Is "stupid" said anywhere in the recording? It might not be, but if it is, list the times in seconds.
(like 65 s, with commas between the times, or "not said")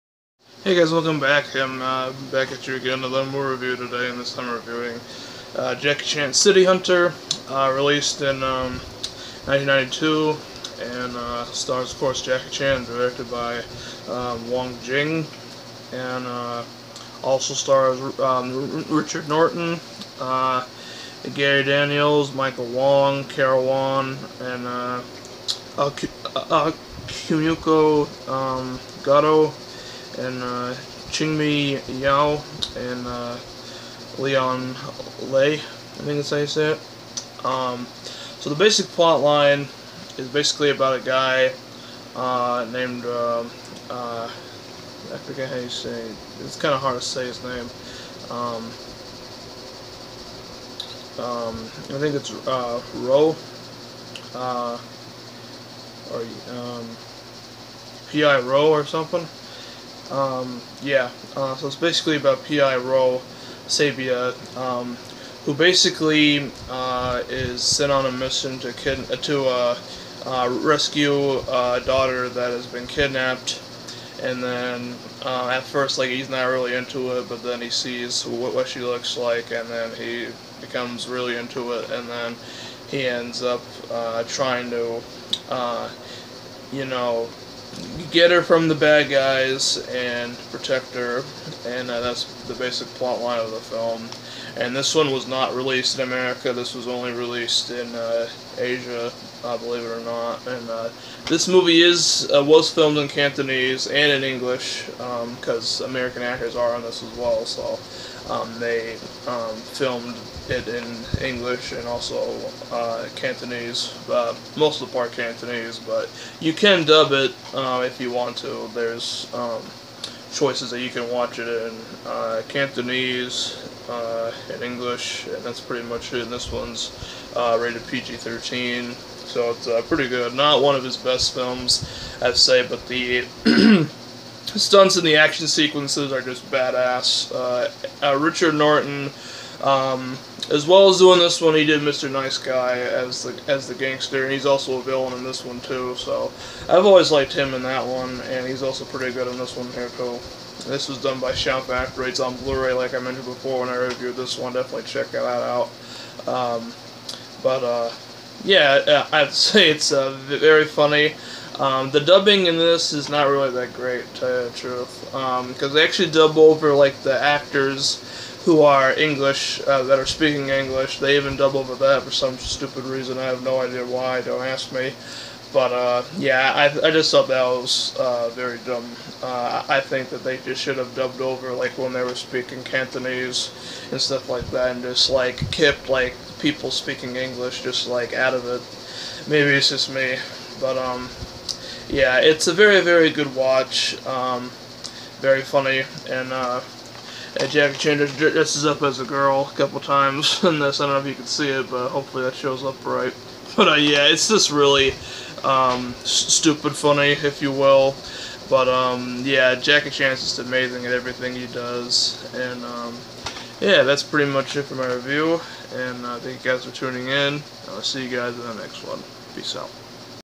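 172 s, 206 s.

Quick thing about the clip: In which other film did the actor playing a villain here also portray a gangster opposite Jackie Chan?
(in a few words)
Mr. Nice Guy.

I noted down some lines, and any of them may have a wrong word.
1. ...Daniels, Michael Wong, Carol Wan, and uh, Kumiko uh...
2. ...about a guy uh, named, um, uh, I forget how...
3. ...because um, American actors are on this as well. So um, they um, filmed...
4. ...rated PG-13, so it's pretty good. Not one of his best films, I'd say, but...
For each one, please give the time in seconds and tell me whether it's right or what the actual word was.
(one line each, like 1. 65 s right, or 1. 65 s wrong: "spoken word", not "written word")
1. 21 s right
2. 40 s right
3. 104 s right
4. 127 s right.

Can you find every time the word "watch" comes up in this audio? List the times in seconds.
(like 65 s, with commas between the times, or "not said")
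121 s, 193 s.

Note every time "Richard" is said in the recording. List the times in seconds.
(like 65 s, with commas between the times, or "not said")
18 s, 138 s.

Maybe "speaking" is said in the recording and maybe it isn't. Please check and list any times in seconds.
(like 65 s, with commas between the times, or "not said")
170 s, 182 s, 186 s.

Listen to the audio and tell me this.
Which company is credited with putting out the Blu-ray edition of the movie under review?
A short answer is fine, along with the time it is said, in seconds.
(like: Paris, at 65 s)
Shout Factory, at 151 s.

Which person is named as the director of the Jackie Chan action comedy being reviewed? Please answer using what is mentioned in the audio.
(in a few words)
Wong Jing.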